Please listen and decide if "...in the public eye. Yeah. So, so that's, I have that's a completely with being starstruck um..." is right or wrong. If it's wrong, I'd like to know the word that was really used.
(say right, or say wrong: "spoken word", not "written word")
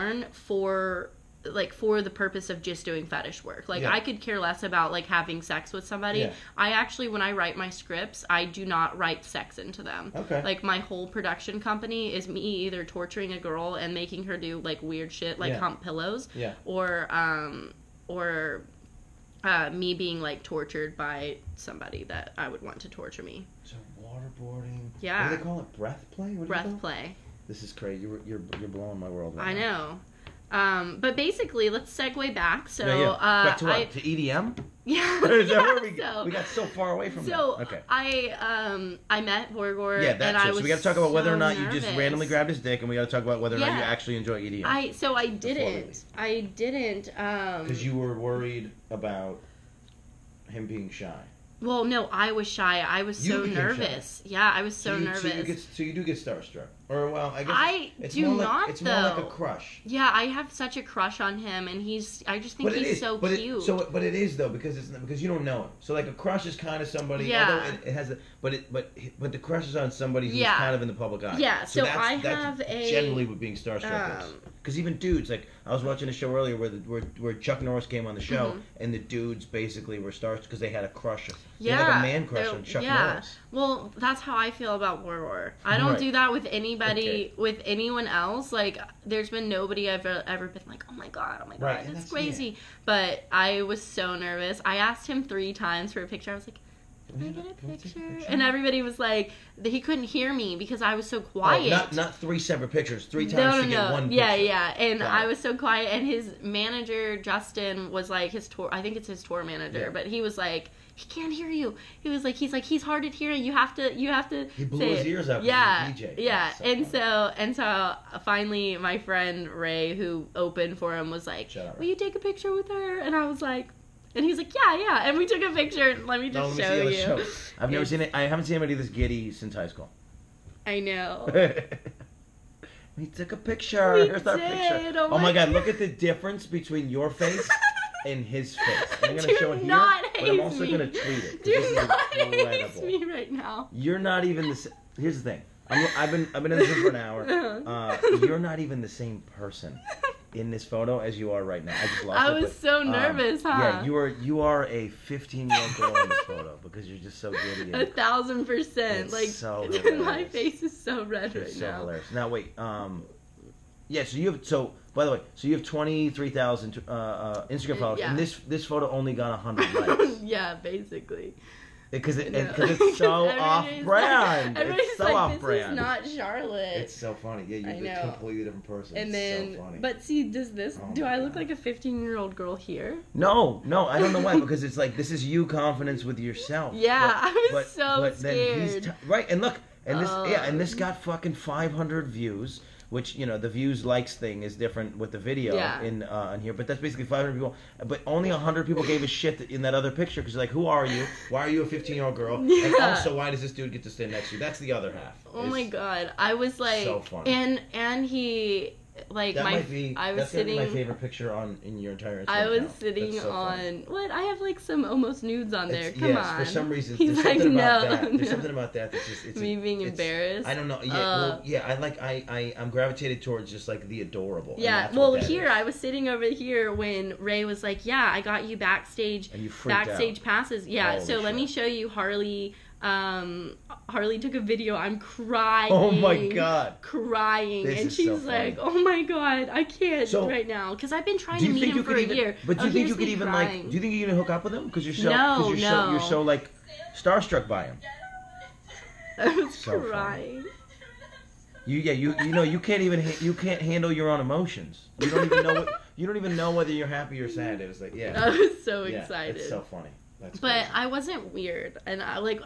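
wrong: "generally", not "completely".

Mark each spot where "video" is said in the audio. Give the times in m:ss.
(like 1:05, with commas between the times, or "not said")
3:15, 3:54.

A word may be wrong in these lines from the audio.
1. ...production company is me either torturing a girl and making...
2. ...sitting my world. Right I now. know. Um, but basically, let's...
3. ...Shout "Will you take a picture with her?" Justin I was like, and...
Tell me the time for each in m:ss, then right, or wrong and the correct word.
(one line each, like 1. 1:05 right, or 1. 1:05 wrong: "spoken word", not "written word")
1. 0:11 right
2. 0:28 wrong: "blowing", not "sitting"
3. 2:01 wrong: "And", not "Justin".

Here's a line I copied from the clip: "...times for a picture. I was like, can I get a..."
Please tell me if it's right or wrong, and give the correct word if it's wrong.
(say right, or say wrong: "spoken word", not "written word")
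right.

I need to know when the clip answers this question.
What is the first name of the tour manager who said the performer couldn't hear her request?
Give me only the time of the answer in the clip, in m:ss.
1:47.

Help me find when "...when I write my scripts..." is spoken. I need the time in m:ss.
0:07.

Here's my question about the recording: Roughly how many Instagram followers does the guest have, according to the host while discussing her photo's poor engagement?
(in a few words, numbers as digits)
23,000.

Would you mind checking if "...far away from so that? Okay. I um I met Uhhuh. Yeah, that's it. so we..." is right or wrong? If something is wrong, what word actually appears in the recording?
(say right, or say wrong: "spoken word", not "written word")
wrong: "Borgore", not "Uhhuh".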